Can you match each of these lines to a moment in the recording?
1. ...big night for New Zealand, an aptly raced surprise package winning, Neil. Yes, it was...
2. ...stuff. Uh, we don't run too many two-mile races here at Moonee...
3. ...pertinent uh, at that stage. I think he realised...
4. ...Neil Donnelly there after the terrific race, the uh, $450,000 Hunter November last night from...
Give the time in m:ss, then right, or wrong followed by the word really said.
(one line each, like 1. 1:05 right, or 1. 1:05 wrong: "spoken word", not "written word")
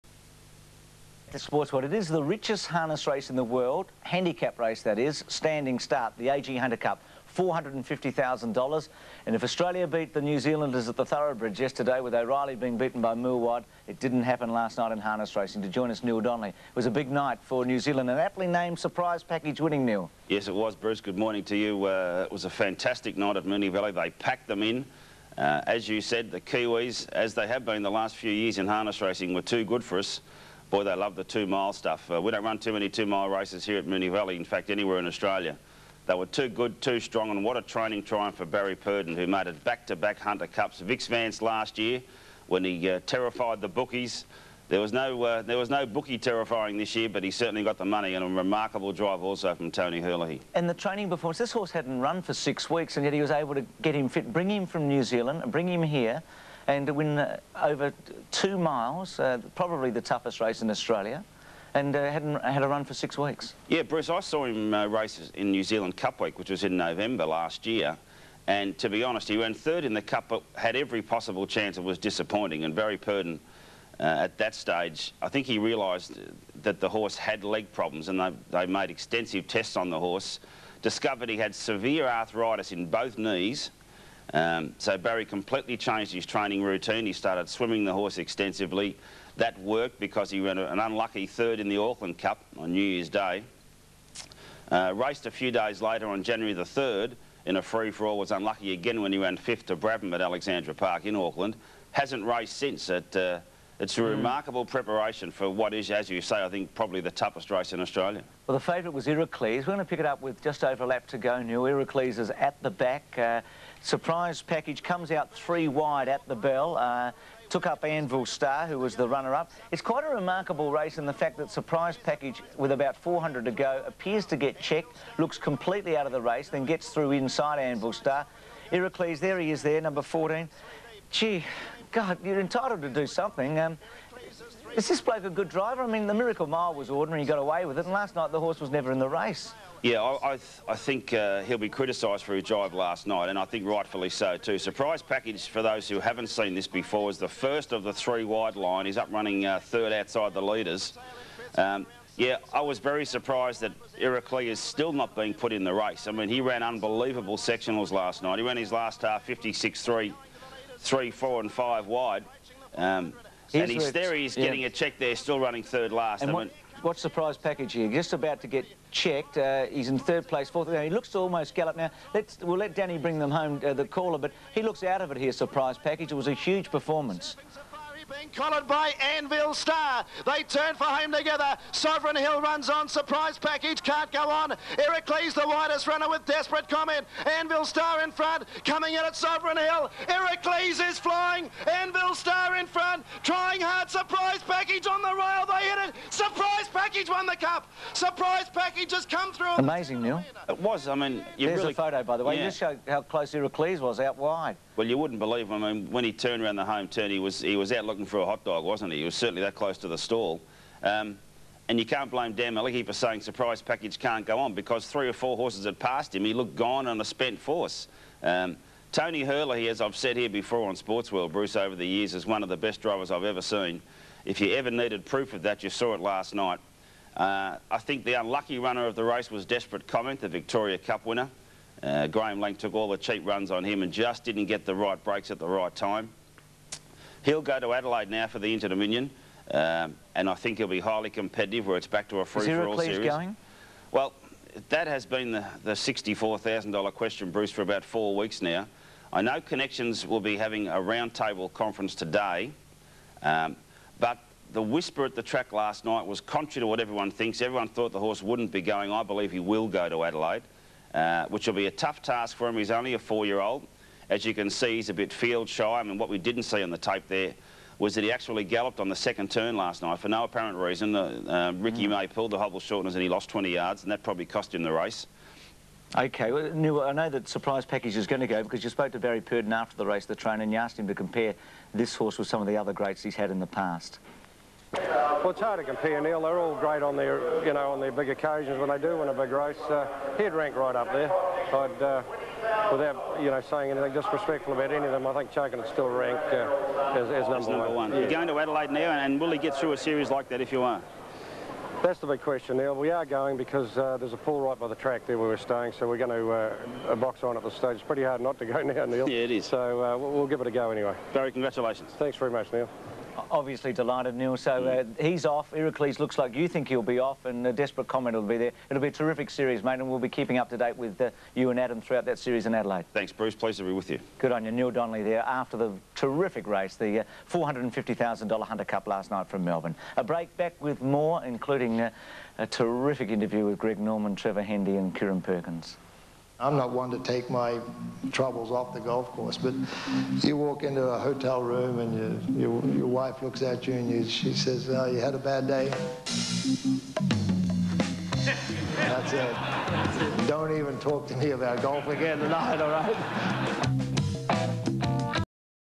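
1. 0:16 wrong: "named", not "raced"
2. 0:31 right
3. 1:12 right
4. 5:24 wrong: "Cup", not "November".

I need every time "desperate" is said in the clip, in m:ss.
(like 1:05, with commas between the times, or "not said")
3:06, 3:49, 5:17.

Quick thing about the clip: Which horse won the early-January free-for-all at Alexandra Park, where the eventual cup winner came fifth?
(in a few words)
Brabham.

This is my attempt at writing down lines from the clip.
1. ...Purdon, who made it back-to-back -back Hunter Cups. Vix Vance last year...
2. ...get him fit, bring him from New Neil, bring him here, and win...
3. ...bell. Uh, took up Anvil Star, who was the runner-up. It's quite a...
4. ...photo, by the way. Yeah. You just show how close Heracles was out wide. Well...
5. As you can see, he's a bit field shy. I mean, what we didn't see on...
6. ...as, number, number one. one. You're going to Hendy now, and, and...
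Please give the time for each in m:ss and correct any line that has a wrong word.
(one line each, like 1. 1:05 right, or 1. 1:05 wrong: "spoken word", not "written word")
1. 0:38 right
2. 0:53 wrong: "Zealand", not "Neil"
3. 1:56 right
4. 3:21 right
5. 4:24 right
6. 4:57 wrong: "Adelaide", not "Hendy".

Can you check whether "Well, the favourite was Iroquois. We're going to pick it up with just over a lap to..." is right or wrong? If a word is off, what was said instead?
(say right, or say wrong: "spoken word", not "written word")
right.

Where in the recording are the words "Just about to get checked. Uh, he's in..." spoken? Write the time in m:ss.
2:47.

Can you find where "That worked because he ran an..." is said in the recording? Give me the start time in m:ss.
1:29.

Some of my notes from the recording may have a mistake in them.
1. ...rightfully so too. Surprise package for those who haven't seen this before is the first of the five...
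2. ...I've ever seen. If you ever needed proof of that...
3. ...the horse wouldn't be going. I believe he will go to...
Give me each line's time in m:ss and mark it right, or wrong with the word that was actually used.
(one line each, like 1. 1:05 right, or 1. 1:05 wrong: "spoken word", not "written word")
1. 2:23 wrong: "three", not "five"
2. 3:43 right
3. 4:17 right.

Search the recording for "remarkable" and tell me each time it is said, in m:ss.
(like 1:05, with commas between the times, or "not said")
0:48, 1:44, 2:00.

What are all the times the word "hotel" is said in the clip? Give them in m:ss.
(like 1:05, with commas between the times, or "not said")
5:40.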